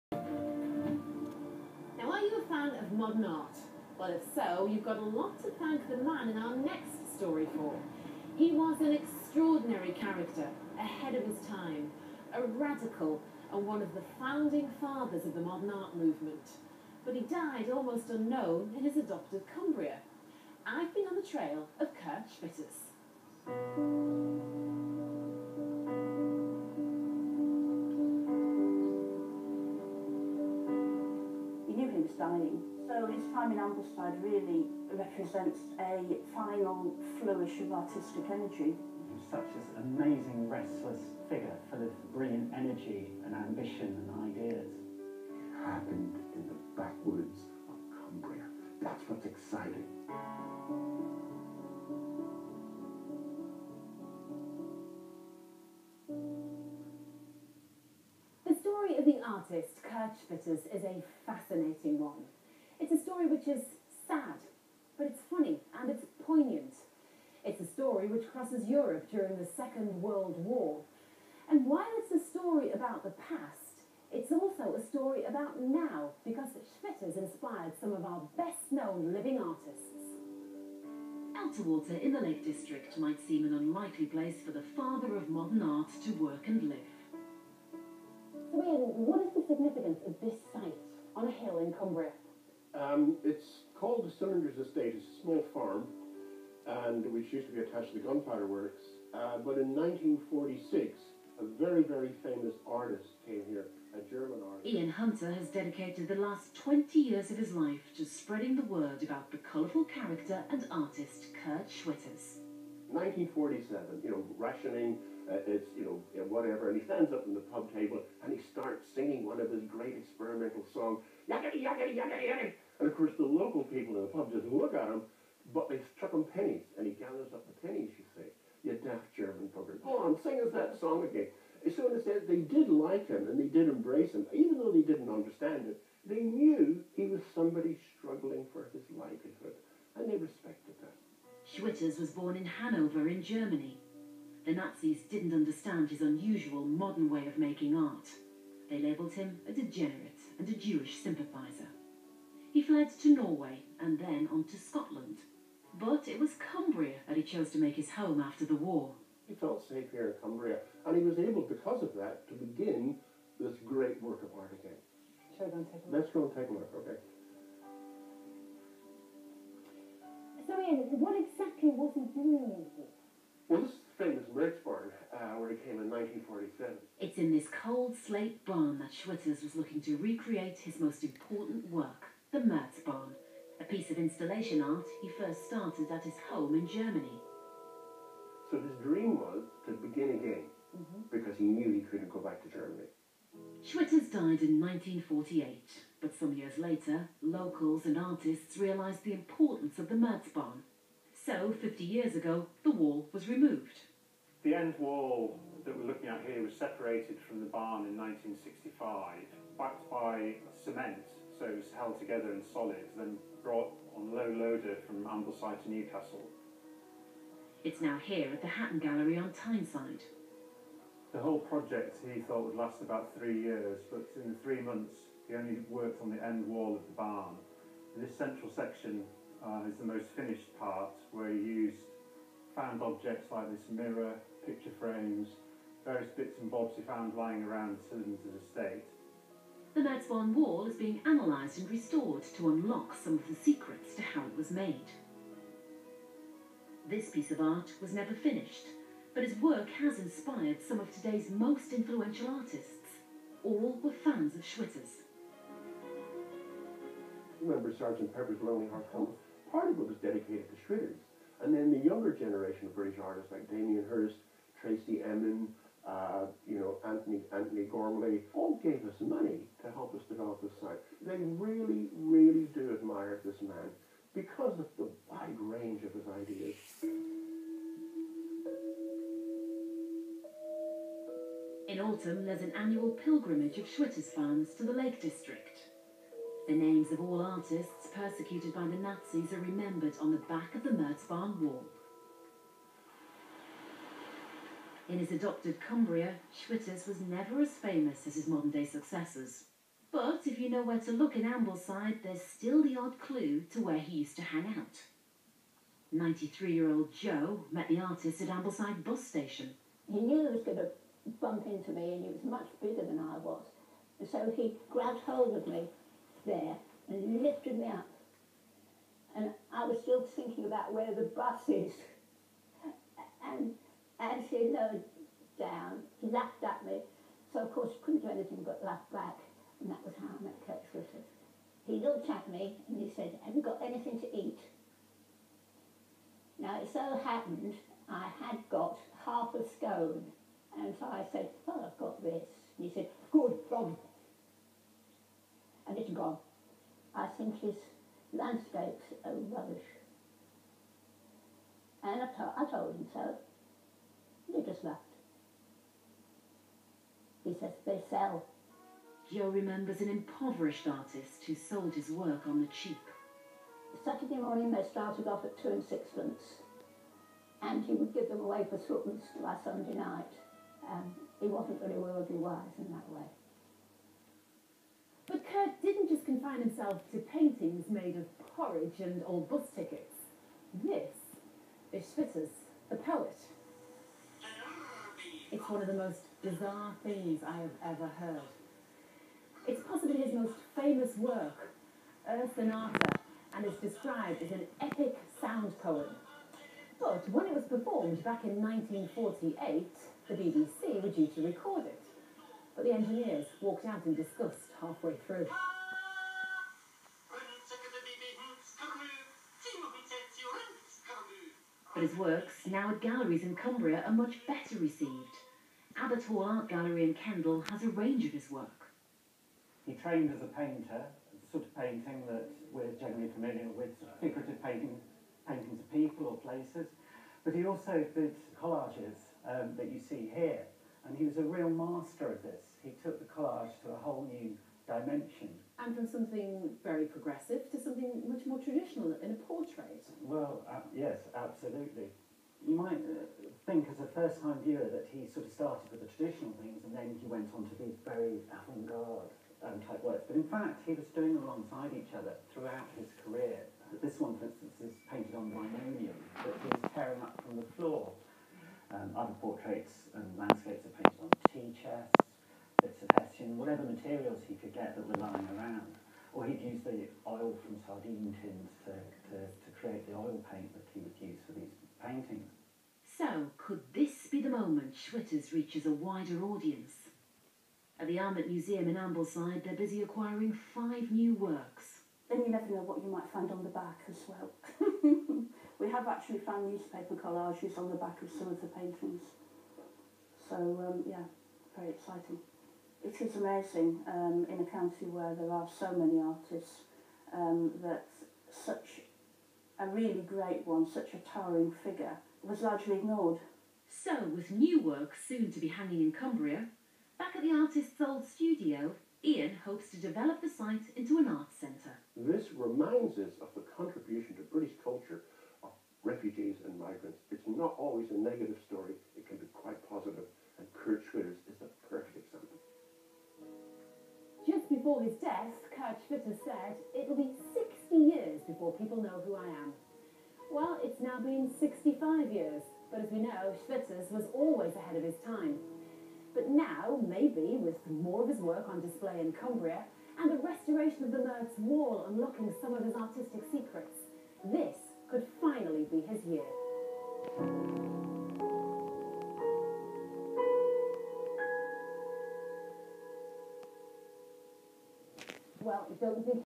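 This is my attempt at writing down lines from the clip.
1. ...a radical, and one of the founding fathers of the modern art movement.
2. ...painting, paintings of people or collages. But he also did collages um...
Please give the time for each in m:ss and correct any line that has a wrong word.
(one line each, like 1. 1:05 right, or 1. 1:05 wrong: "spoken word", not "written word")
1. 0:12 right
2. 7:04 wrong: "places", not "collages".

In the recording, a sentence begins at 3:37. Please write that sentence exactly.
It's now here at the Hatton Gallery on Tyneside.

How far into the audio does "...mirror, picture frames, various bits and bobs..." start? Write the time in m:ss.
3:53.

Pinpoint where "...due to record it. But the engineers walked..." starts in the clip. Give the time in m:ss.
6:40.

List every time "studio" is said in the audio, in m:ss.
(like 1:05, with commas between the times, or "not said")
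8:28.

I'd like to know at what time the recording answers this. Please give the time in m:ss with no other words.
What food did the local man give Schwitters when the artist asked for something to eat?
5:39.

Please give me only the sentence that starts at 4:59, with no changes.
But if you know where to look in Ambleside, there's still the odd clue to where he used to hang out.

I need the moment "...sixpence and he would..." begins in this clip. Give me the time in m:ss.
6:05.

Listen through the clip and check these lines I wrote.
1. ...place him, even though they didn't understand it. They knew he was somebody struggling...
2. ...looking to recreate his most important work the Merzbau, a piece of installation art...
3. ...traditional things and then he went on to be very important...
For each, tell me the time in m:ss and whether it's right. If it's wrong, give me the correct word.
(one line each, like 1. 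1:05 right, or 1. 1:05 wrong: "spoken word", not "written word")
1. 2:13 wrong: "embrace", not "place"
2. 2:59 right
3. 7:25 wrong: "avant", not "important".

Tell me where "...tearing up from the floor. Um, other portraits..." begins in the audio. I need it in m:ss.
7:36.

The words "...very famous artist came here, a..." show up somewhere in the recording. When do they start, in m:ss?
1:41.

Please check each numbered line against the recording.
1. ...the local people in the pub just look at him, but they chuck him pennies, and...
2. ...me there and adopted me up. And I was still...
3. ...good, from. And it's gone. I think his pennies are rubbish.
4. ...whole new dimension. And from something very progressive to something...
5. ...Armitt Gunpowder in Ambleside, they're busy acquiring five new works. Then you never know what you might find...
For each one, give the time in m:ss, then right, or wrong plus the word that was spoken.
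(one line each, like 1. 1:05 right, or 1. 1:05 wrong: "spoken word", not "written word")
1. 2:03 right
2. 5:15 wrong: "lifted", not "adopted"
3. 5:43 wrong: "landscapes", not "pennies"
4. 7:13 right
5. 7:57 wrong: "Museum", not "Gunpowder".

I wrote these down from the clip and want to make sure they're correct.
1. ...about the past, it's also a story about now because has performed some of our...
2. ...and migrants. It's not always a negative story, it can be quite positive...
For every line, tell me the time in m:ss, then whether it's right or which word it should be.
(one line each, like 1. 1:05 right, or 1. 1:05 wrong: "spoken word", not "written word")
1. 1:12 wrong: "inspired", not "performed"
2. 8:36 right.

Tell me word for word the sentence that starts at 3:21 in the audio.
So, 50 years ago, the wall was removed.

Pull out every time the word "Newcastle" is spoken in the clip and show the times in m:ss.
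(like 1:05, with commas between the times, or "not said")
3:35.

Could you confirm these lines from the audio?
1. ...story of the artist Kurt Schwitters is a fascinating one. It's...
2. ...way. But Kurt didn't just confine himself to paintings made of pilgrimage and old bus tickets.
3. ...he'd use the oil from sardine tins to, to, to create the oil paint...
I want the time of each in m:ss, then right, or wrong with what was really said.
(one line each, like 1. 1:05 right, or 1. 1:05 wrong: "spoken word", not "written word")
1. 0:58 right
2. 6:12 wrong: "porridge", not "pilgrimage"
3. 7:46 right.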